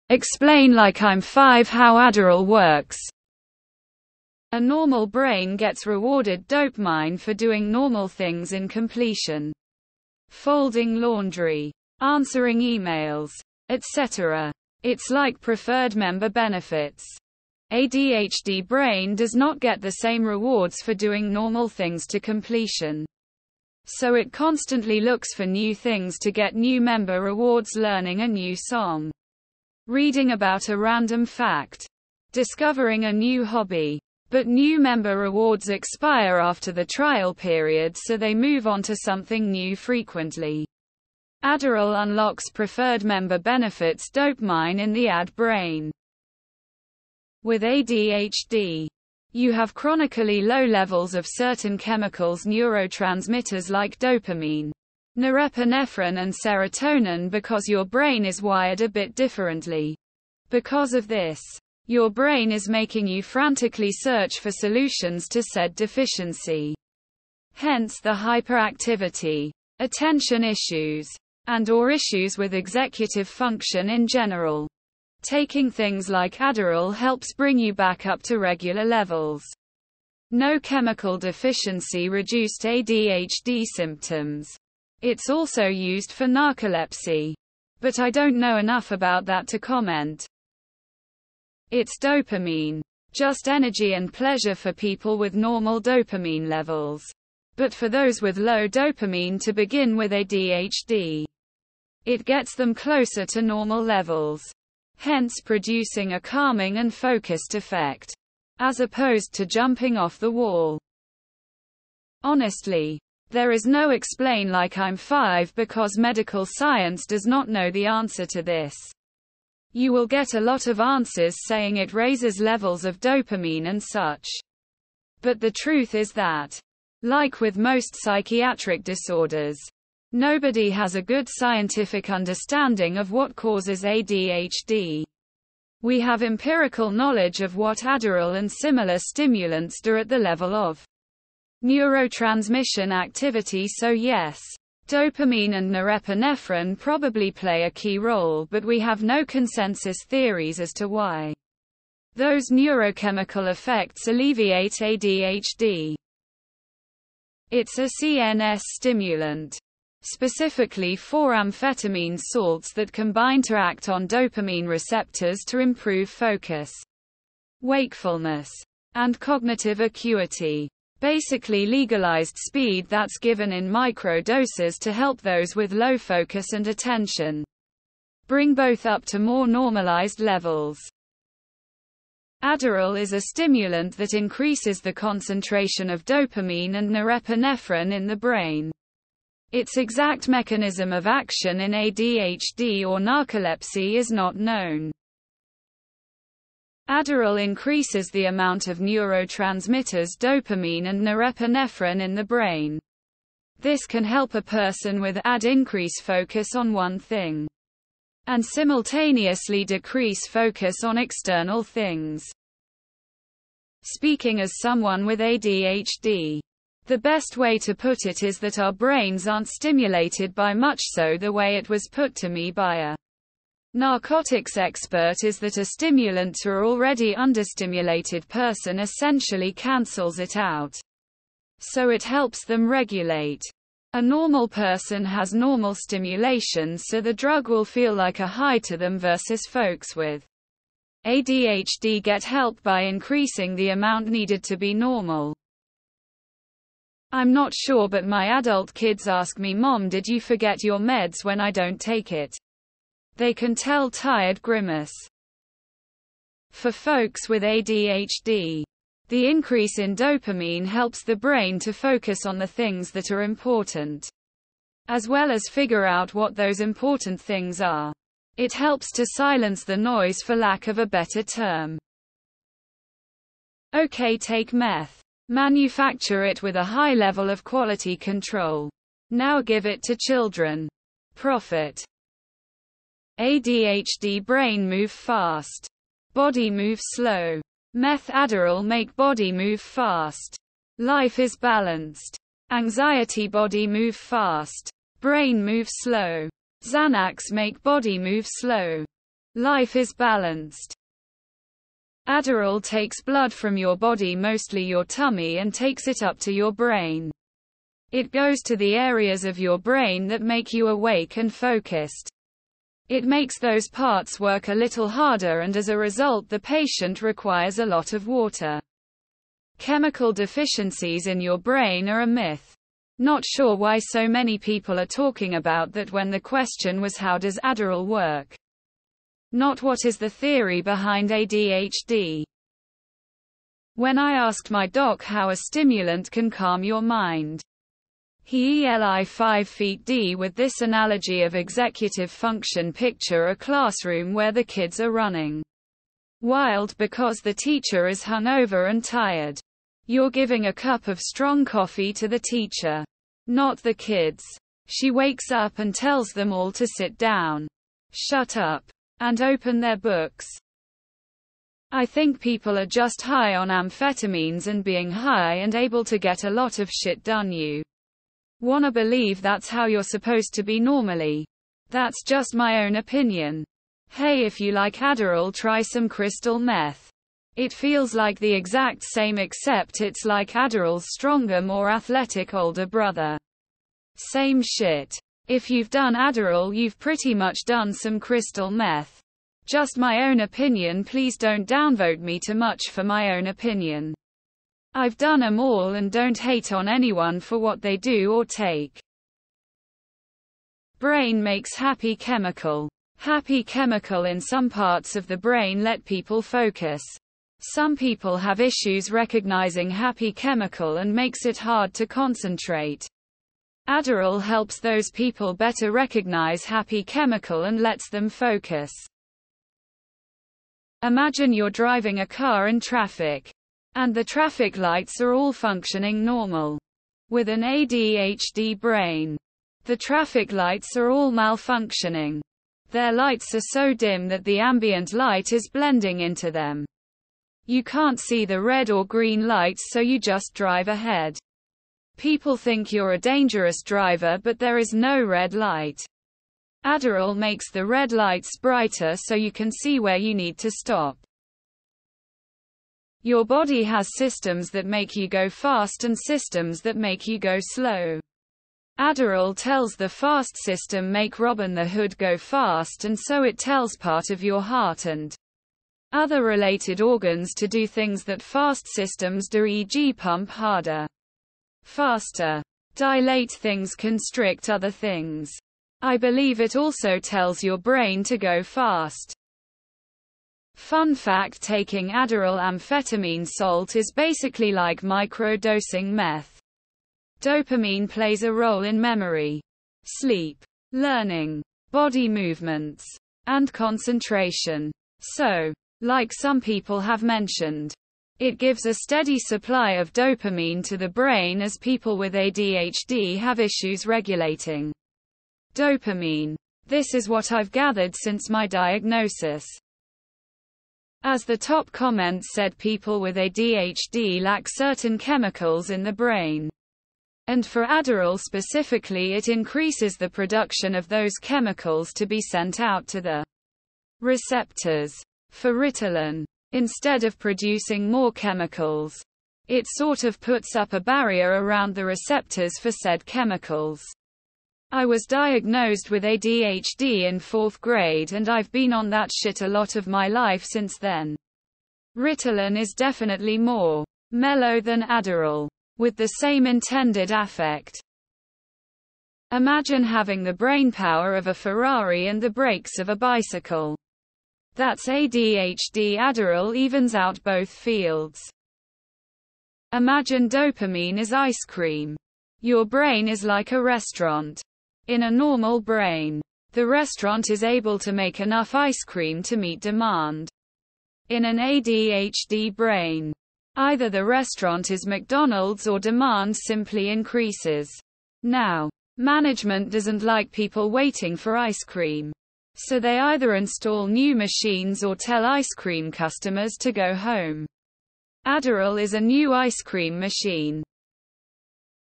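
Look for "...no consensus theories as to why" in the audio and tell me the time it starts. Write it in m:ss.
2:29.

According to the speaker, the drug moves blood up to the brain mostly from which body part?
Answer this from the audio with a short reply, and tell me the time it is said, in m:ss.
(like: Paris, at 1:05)
Tummy, at 5:04.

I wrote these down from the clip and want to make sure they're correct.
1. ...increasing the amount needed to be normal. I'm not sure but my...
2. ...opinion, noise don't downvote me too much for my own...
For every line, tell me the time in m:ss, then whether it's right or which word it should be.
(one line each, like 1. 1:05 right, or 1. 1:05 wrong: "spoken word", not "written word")
1. 4:02 right
2. 6:30 wrong: "please", not "noise".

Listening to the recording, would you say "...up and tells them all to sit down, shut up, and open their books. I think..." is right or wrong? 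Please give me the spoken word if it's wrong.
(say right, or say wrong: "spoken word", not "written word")
right.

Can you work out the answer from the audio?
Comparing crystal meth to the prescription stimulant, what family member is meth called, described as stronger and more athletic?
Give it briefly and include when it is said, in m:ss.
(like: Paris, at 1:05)
Older brother, at 6:22.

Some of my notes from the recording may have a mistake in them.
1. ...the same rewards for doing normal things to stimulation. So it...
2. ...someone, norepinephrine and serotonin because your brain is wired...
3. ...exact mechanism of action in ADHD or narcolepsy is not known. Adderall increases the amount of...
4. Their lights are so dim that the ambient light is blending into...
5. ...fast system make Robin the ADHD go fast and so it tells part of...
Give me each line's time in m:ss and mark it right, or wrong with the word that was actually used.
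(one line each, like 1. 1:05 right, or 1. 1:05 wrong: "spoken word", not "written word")
1. 0:19 wrong: "completion", not "stimulation"
2. 0:53 wrong: "dopamine", not "someone"
3. 3:09 right
4. 7:12 right
5. 7:39 wrong: "Hood", not "ADHD".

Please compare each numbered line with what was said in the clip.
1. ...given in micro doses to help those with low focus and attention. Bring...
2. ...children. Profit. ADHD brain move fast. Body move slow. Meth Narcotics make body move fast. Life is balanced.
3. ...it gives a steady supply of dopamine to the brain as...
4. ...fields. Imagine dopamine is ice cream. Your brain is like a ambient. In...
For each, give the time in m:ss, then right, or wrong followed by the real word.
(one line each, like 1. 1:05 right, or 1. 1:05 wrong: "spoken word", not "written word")
1. 2:53 right
2. 4:39 wrong: "Adderall", not "Narcotics"
3. 8:18 right
4. 9:17 wrong: "restaurant", not "ambient".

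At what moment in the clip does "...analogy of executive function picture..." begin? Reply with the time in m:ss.
5:40.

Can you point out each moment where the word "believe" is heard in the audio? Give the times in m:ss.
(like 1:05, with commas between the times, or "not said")
6:08, 7:55.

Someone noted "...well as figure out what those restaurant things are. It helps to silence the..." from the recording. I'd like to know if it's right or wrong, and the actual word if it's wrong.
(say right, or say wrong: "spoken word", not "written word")
wrong: "important", not "restaurant".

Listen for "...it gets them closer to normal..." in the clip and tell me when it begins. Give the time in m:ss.
1:42.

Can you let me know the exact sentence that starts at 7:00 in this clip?
Imagine you're driving a car in traffic and the traffic lights are all functioning normal.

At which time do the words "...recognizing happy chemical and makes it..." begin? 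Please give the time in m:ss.
6:48.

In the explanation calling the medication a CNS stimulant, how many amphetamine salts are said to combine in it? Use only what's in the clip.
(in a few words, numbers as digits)
4.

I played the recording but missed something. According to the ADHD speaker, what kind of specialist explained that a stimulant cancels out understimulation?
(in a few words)
Narcotics expert.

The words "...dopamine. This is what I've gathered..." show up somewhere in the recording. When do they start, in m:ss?
8:25.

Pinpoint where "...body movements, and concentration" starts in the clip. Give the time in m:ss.
8:11.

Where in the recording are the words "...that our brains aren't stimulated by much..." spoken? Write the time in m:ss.
3:38.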